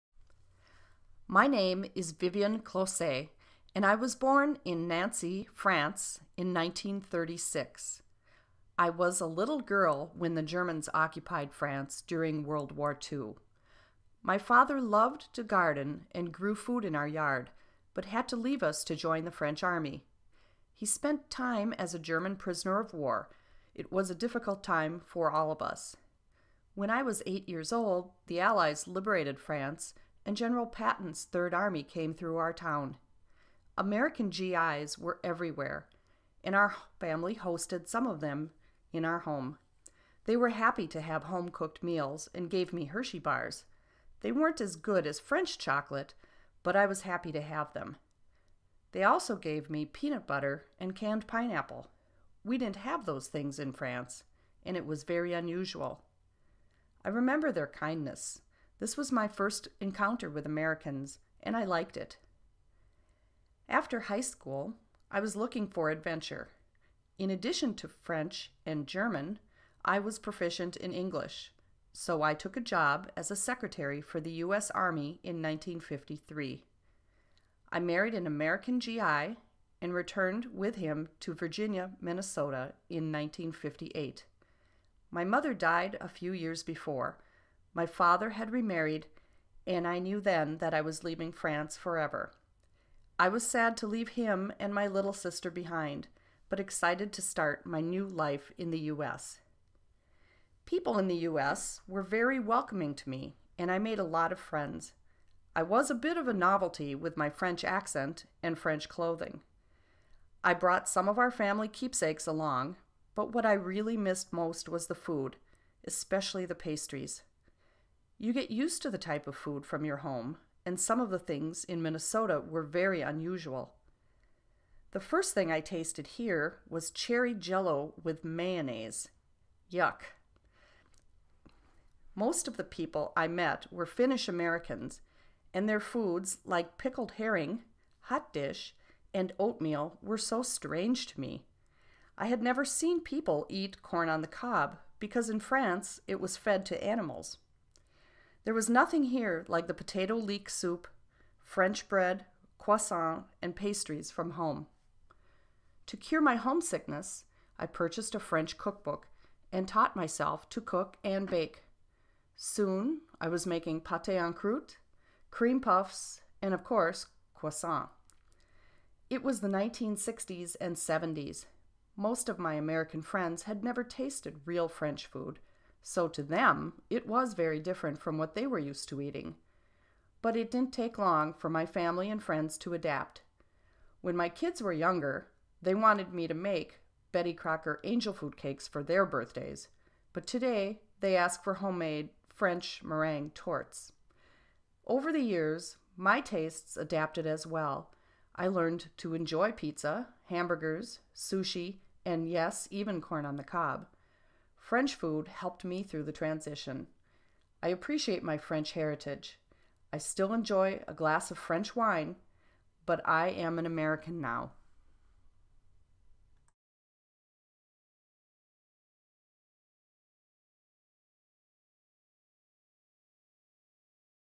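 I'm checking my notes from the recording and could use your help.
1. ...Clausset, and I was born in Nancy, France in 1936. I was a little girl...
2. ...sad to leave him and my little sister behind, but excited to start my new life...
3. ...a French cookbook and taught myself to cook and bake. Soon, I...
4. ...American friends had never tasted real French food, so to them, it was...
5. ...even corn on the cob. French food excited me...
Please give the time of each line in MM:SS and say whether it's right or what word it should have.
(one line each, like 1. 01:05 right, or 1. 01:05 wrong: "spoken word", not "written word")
1. 00:02 right
2. 01:33 right
3. 02:38 right
4. 02:52 right
5. 03:22 wrong: "helped", not "excited".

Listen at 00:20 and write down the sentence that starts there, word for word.
He spent time as a German prisoner of war.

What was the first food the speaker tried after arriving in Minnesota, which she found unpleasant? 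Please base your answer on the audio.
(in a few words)
Cherry jello with mayonnaise.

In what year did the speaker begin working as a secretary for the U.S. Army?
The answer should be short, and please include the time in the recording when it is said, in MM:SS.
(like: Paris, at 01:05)
1953, at 01:15.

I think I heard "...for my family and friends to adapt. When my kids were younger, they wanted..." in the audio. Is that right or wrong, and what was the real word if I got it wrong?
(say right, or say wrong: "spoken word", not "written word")
right.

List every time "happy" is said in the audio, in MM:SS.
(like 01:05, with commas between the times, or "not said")
00:40, 00:47.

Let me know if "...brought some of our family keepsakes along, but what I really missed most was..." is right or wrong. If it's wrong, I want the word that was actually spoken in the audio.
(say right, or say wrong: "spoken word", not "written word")
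right.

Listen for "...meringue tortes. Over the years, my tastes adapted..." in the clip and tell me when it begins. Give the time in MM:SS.
03:12.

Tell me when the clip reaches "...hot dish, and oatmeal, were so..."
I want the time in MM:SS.
02:18.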